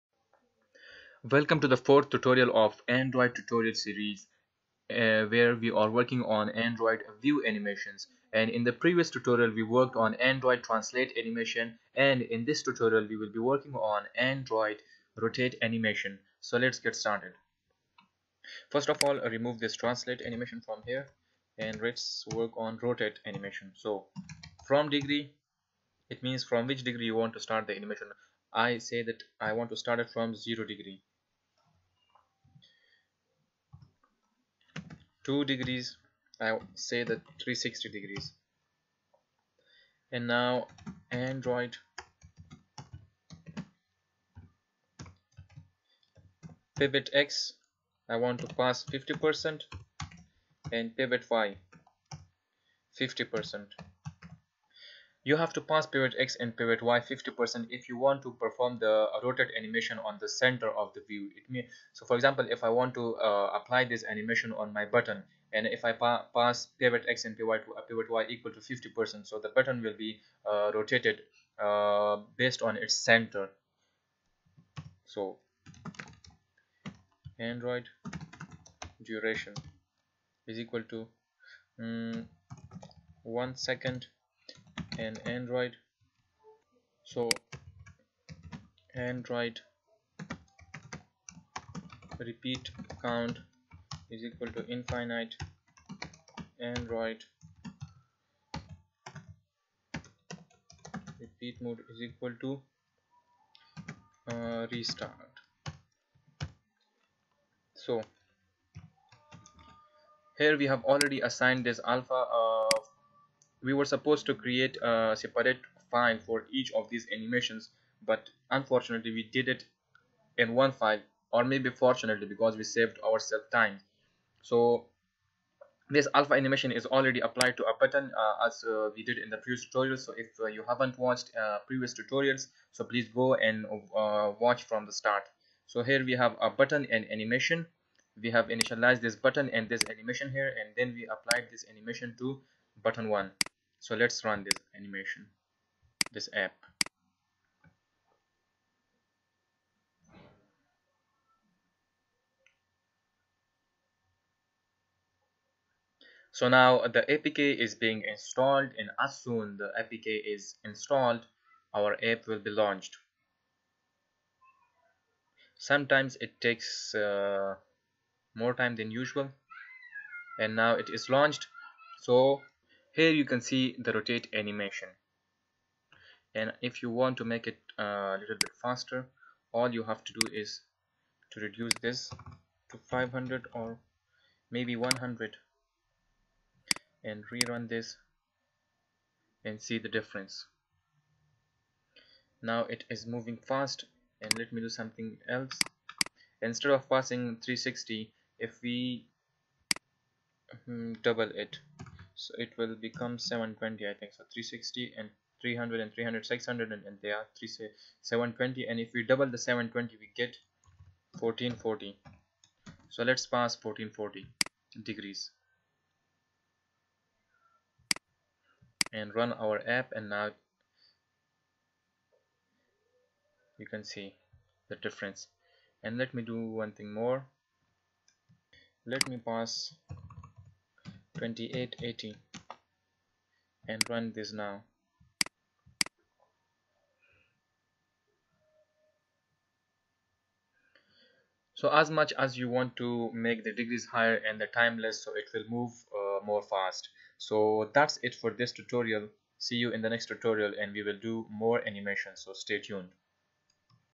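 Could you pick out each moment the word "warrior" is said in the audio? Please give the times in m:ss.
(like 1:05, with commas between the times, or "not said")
not said.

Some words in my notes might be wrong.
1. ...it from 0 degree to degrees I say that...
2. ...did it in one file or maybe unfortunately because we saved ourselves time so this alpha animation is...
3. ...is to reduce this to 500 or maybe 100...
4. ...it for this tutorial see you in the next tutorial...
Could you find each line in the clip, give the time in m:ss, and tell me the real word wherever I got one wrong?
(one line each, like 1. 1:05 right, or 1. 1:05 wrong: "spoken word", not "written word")
1. 0:29 right
2. 1:59 wrong: "fortunately", not "unfortunately"
3. 3:00 right
4. 4:08 right.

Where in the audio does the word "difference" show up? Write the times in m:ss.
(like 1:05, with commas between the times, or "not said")
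3:09, 3:44.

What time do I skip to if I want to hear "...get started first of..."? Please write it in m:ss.
0:16.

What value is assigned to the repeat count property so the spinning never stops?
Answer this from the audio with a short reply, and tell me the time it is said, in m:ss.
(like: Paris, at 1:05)
infinite, at 1:34.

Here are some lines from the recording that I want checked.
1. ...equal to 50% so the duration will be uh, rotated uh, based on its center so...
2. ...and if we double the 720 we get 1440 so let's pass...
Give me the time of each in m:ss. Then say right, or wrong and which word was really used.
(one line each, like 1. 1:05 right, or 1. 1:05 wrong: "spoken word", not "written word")
1. 1:08 wrong: "button", not "duration"
2. 3:28 right.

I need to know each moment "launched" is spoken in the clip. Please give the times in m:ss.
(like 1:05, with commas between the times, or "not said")
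2:42, 2:51.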